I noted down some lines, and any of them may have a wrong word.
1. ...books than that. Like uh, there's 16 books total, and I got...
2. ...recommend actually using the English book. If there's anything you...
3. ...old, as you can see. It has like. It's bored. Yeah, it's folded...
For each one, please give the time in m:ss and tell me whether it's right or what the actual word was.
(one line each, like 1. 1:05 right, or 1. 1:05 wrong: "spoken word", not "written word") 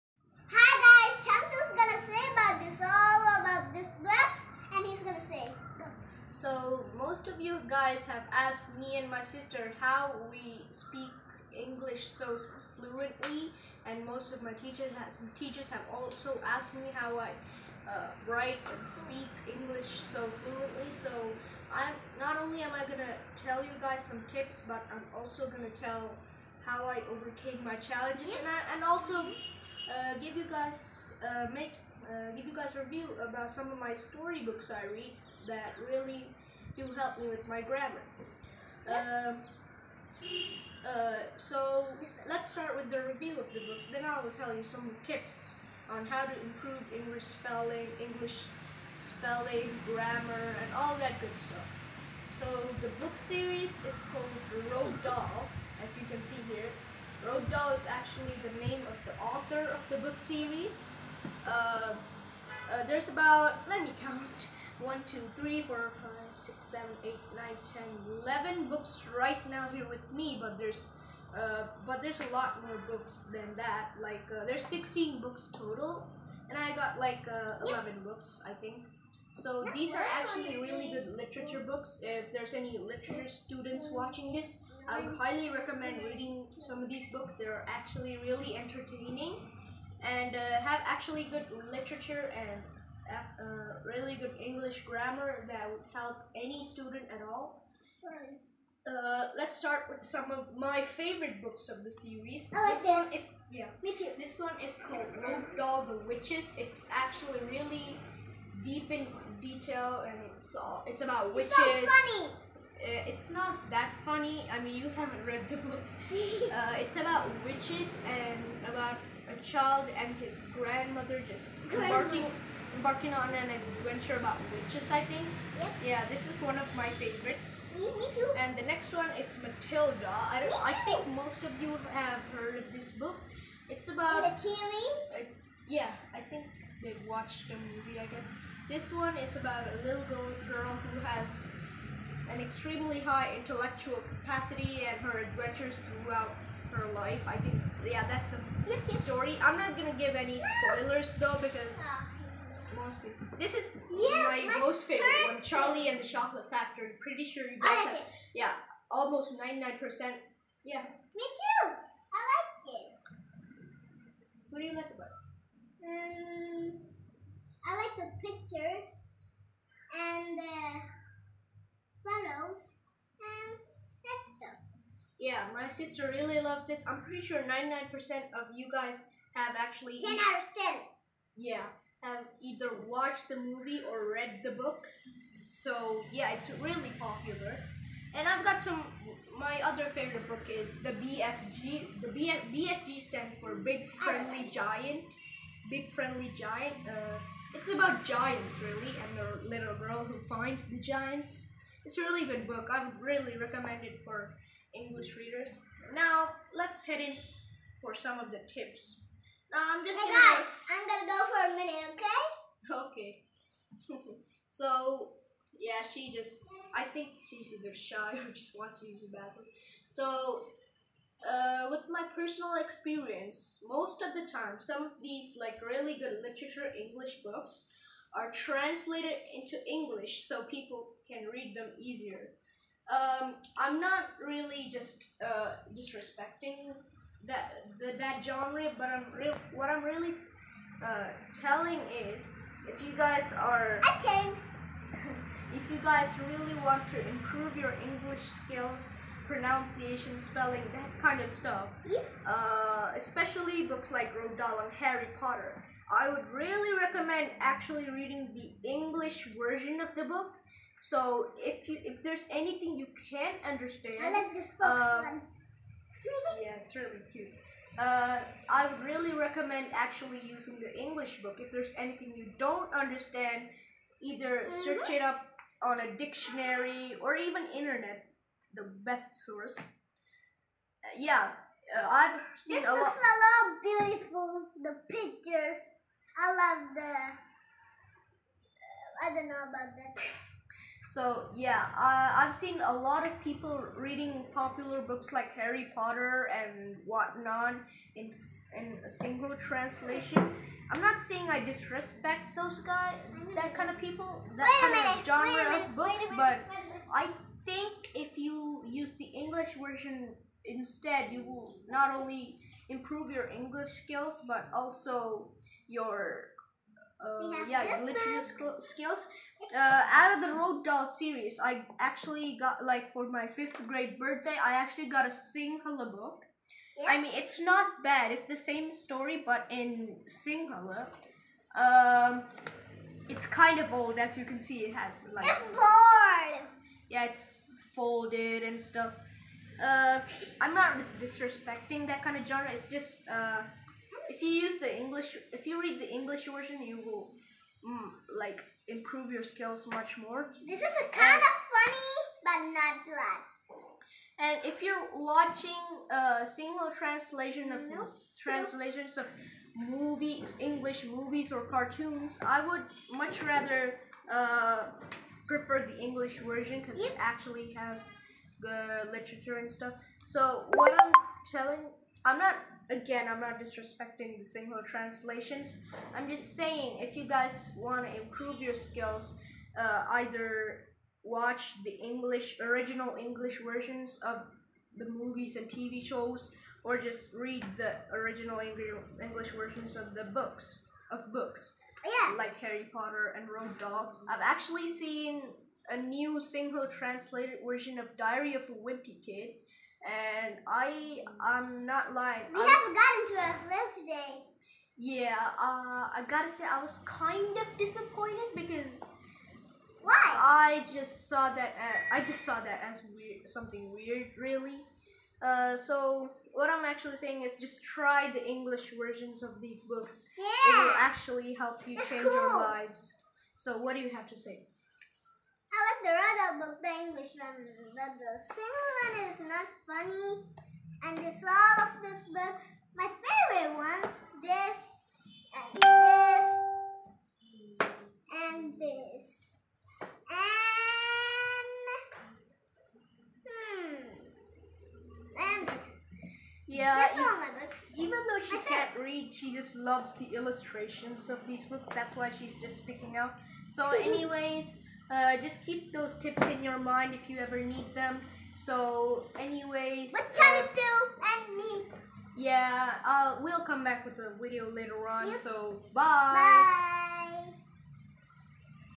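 1. 1:12 right
2. 4:29 right
3. 5:33 right.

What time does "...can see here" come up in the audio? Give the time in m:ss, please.
0:56.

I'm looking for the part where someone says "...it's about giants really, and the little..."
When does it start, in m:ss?
3:17.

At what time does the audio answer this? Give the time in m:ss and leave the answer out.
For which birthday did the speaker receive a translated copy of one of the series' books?
5:23.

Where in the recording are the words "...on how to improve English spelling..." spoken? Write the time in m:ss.
0:45.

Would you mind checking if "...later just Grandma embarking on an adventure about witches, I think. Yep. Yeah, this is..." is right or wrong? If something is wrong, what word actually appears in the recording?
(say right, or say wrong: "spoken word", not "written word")
wrong: "grandmother", not "later".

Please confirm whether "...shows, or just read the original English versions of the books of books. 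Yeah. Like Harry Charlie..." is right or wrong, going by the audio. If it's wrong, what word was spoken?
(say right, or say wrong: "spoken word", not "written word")
wrong: "Potter", not "Charlie".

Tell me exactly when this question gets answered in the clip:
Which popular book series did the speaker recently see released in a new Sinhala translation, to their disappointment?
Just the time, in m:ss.
6:37.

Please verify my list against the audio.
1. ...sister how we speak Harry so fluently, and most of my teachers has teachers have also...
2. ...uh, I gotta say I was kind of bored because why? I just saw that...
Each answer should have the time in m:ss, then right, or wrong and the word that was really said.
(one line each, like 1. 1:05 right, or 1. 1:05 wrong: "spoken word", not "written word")
1. 0:09 wrong: "English", not "Harry"
2. 6:45 wrong: "disappointed", not "bored".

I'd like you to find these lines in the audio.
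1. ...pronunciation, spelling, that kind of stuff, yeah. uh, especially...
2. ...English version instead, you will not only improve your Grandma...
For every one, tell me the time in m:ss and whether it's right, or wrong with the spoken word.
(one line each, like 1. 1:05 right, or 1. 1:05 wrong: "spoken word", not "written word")
1. 4:09 right
2. 5:09 wrong: "English", not "Grandma".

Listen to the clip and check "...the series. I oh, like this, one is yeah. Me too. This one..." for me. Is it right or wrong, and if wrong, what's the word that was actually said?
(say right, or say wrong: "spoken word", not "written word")
right.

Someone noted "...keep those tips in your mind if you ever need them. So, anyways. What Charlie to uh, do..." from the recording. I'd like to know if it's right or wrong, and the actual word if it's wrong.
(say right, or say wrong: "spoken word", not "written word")
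right.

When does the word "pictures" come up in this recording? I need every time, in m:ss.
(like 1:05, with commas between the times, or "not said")
2:48, 4:44.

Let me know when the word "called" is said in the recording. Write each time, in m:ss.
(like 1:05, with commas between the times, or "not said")
0:54, 1:44.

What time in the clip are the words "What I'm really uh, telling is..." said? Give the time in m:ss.
3:59.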